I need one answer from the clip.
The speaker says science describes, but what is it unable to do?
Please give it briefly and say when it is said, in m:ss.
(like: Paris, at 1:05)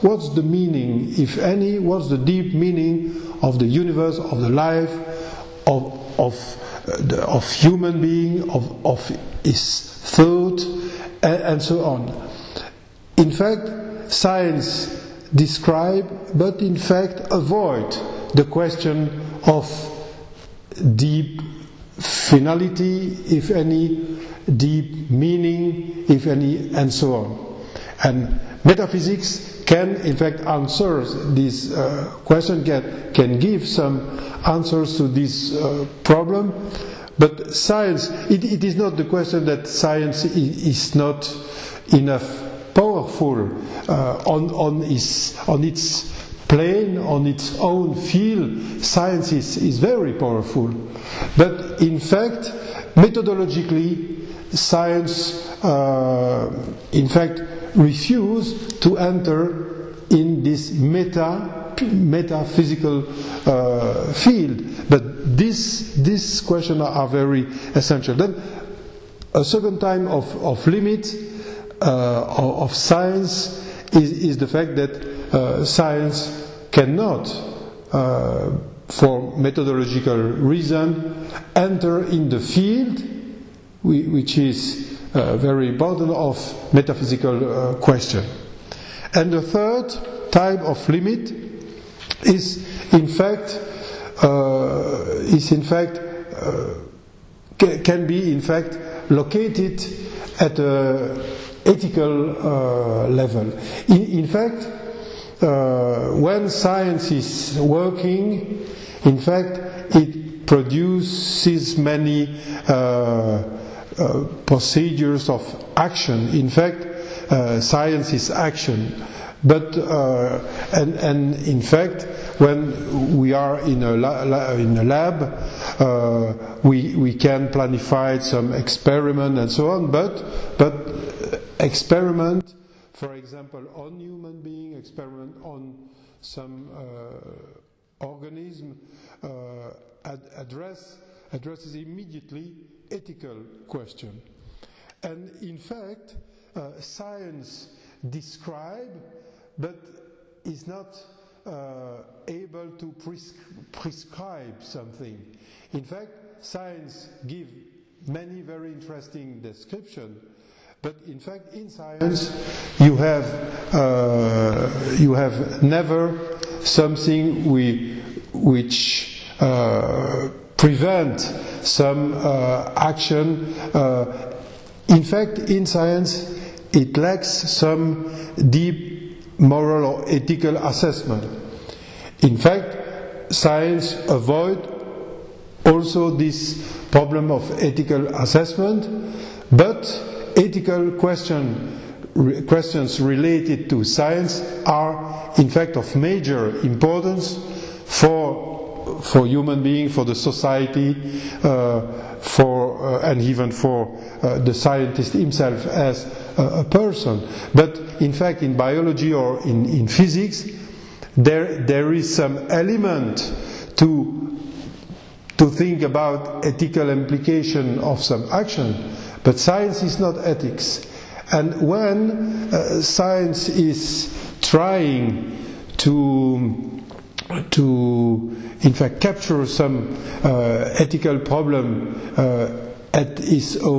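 Prescribe, at 2:32.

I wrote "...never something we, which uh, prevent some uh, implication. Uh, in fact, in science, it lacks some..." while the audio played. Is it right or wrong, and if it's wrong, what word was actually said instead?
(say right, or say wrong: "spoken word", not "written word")
wrong: "action", not "implication".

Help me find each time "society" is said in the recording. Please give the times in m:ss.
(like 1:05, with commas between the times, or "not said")
3:20.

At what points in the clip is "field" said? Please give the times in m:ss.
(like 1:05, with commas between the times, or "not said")
0:47, 1:04, 1:22.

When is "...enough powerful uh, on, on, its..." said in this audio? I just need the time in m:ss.
0:41.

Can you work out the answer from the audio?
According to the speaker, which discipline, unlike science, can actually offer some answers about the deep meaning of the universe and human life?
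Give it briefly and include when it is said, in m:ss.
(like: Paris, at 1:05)
Metaphysics, at 0:28.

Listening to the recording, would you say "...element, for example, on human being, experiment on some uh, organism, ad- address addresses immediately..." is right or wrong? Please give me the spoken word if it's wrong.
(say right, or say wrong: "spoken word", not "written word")
wrong: "experiment", not "element".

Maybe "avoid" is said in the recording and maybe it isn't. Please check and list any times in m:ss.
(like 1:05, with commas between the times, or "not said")
0:17, 3:04.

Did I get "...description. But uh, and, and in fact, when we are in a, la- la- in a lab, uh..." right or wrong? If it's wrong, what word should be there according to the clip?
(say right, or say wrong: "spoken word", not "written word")
wrong: "action", not "description".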